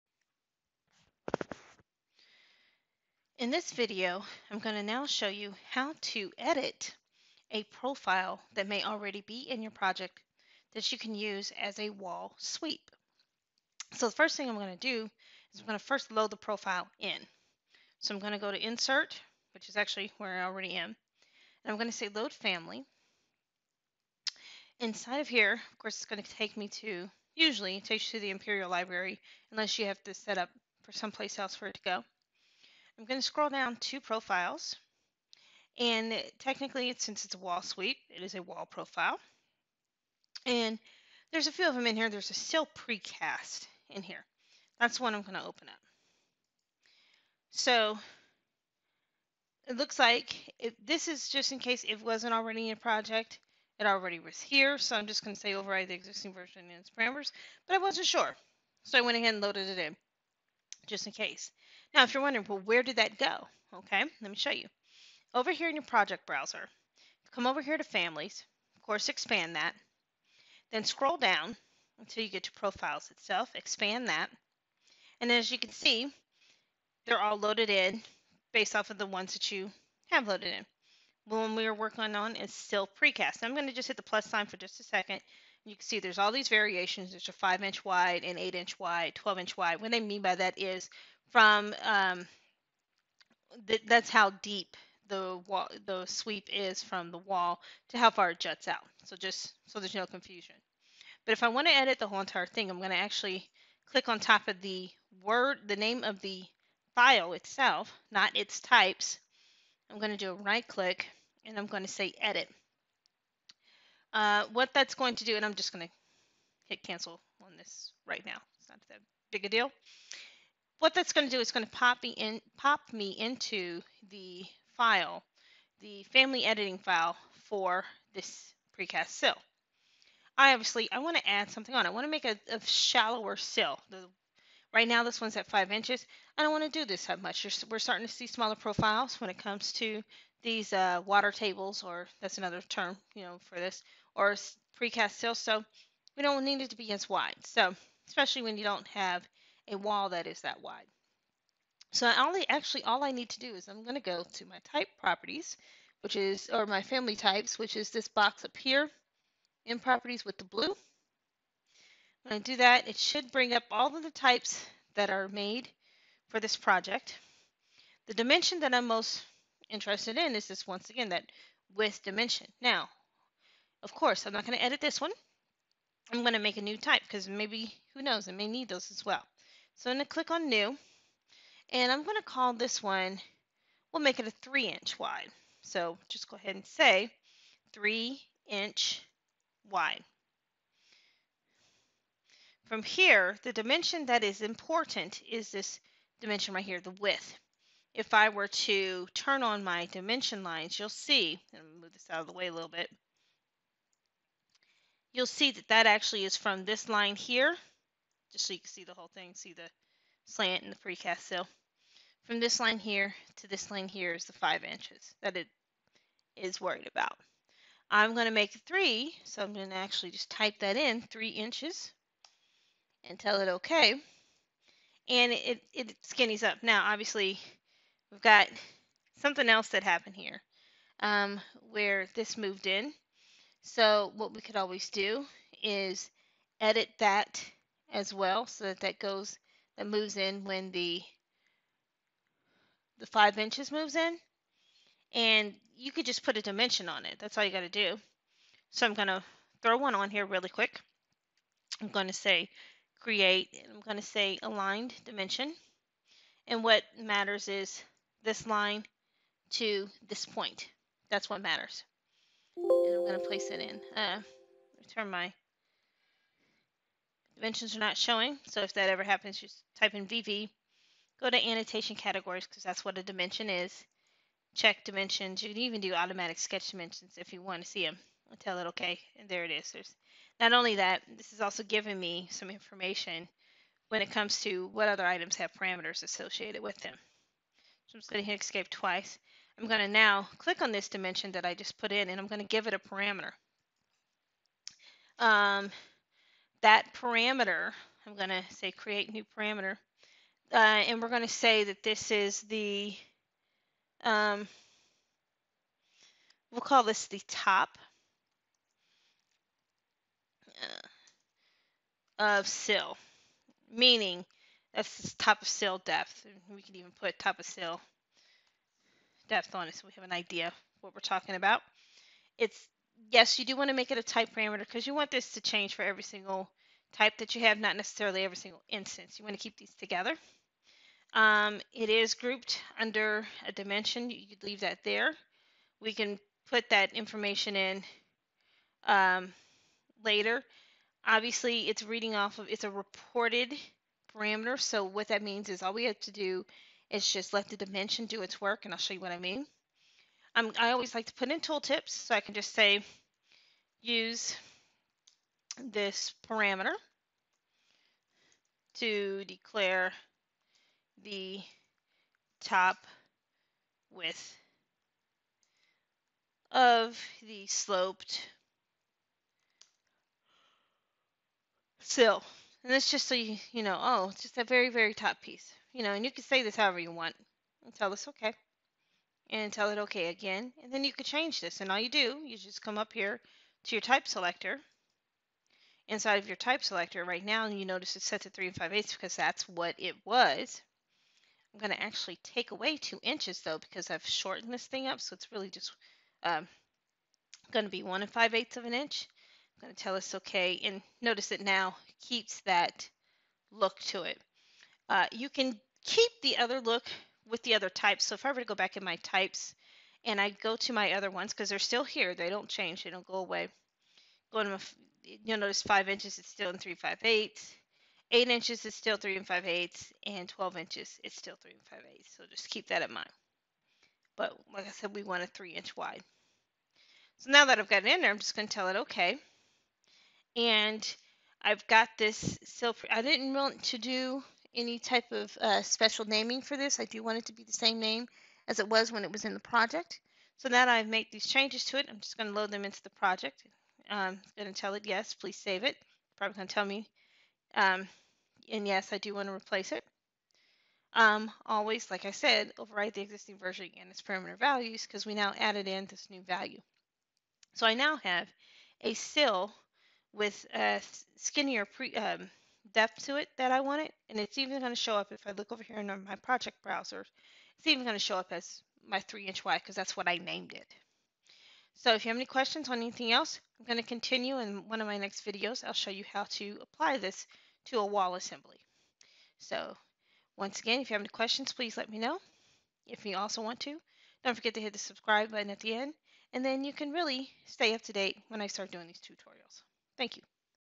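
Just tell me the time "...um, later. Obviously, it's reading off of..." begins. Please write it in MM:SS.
05:38.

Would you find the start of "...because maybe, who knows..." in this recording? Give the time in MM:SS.
02:57.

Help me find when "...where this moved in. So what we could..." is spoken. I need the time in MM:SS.
03:51.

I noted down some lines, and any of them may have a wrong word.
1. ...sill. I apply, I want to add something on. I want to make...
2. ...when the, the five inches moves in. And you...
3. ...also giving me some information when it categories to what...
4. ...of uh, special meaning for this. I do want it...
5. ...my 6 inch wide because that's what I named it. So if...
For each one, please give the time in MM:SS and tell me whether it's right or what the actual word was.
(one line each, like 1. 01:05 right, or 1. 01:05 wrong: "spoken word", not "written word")
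1. 02:09 wrong: "obviously", not "apply"
2. 04:00 right
3. 04:41 wrong: "comes", not "categories"
4. 07:15 wrong: "naming", not "meaning"
5. 07:48 wrong: "3", not "6".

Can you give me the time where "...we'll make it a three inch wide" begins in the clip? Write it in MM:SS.
03:03.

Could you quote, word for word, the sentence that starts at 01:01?
Now, if you're wondering, well, where did that go?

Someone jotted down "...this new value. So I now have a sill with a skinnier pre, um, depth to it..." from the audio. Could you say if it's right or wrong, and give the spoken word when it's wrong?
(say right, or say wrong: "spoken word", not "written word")
right.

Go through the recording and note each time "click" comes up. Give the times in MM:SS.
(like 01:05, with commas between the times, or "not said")
01:43, 01:50, 03:00, 04:50.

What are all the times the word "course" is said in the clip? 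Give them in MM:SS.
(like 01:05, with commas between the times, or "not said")
00:25, 01:08, 02:53.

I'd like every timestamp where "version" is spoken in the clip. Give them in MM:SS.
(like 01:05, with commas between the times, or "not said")
00:56, 07:33.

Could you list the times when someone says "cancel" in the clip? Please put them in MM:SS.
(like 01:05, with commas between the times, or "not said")
01:56.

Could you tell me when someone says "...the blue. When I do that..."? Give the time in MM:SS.
02:40.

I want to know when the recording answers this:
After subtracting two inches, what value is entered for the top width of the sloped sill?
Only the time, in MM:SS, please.
06:37.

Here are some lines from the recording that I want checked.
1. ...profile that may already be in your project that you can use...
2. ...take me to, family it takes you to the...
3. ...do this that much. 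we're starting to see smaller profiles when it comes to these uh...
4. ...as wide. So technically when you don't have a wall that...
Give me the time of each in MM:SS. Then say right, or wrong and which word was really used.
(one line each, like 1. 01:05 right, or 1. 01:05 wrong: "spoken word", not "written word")
1. 00:07 right
2. 00:26 wrong: "usually", not "family"
3. 02:16 right
4. 02:26 wrong: "especially", not "technically".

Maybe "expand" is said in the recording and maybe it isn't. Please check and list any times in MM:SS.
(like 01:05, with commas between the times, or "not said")
01:09, 01:13.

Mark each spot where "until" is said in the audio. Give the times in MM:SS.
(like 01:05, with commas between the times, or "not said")
01:11.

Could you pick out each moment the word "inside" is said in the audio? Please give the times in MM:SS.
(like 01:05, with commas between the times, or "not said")
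00:24, 06:25.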